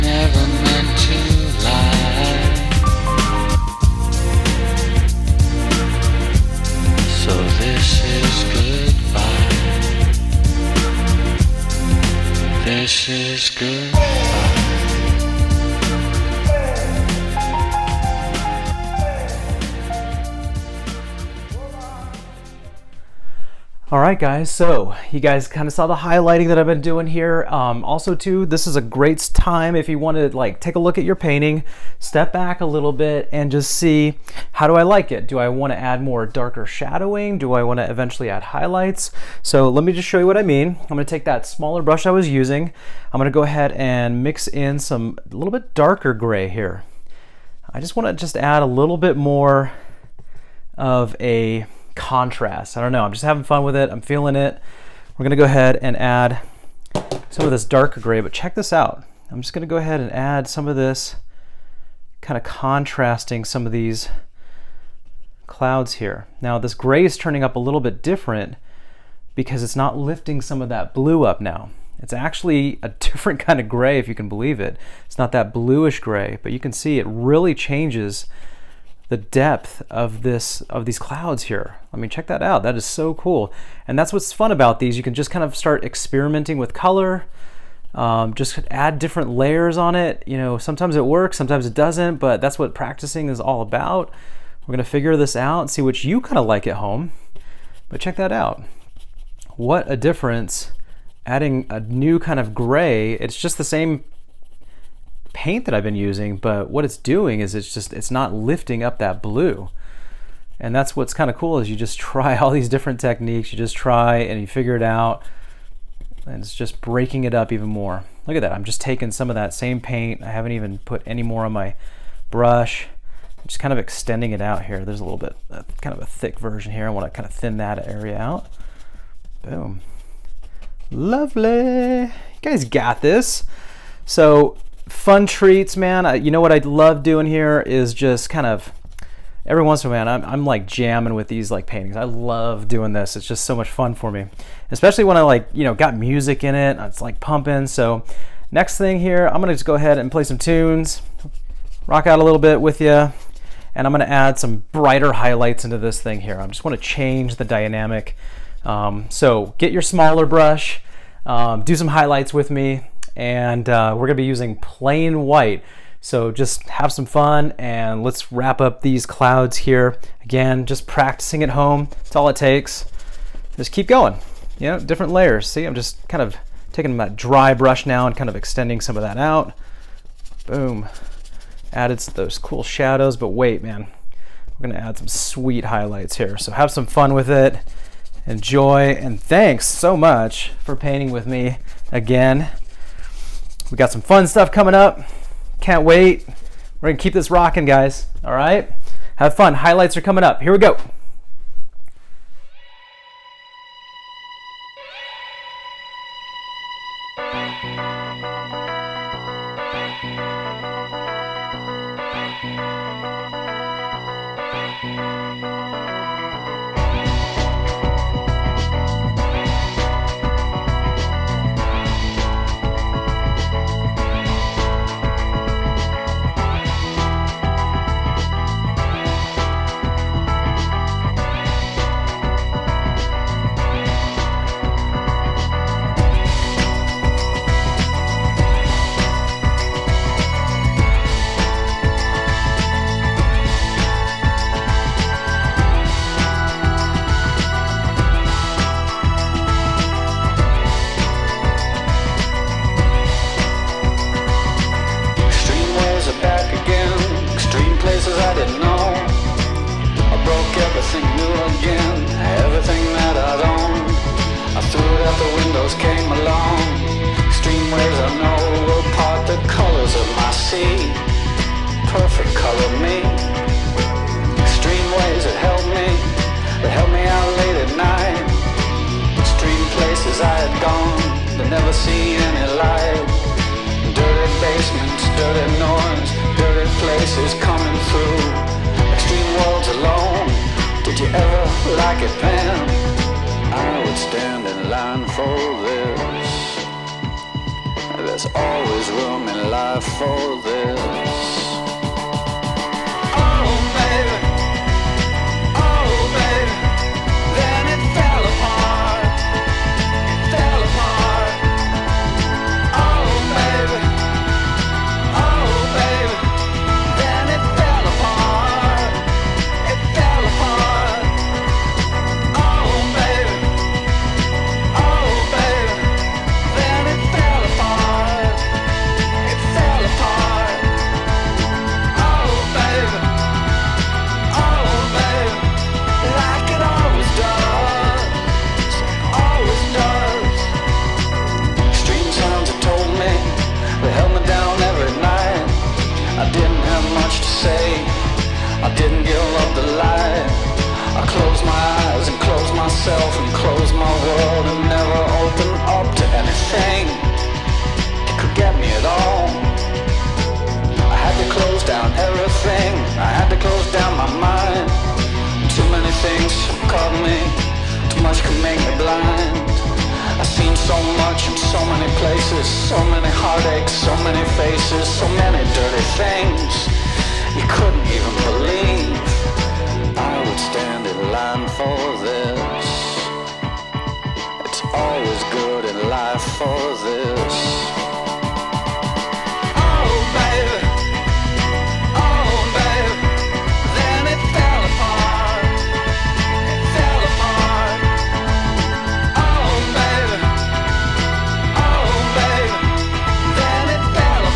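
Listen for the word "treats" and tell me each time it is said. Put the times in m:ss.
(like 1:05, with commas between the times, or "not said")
2:15.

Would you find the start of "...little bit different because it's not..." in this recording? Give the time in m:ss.
1:07.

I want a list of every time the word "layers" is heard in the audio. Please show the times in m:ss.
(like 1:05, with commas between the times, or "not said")
1:29, 2:55.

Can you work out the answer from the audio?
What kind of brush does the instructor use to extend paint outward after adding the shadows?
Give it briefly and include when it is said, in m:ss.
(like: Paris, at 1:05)
dry brush, at 2:57.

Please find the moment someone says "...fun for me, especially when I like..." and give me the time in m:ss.
2:23.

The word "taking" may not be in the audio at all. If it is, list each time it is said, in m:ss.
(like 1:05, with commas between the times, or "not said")
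1:58, 2:56.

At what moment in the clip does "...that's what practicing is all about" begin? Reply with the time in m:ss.
1:32.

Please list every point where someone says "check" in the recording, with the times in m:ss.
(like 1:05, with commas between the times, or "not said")
0:58, 1:22, 1:38.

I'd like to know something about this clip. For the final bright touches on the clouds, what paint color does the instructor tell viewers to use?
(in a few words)
plain white.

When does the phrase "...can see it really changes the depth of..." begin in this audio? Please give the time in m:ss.
1:16.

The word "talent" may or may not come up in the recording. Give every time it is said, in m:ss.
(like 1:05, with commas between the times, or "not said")
not said.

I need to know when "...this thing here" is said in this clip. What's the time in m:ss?
2:35.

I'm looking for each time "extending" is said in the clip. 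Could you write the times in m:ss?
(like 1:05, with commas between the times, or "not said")
2:03, 2:58.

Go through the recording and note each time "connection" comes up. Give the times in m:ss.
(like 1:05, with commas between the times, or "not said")
not said.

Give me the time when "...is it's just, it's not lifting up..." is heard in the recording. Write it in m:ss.
1:47.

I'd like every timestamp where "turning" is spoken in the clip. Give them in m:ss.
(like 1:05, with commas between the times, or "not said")
1:07.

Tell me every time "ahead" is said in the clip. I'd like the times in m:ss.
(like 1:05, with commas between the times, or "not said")
0:43, 0:55, 0:59, 2:29.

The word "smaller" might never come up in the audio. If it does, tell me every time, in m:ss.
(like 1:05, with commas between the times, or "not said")
0:41, 2:39.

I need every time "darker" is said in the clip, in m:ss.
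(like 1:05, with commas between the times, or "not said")
0:36, 0:45, 0:57.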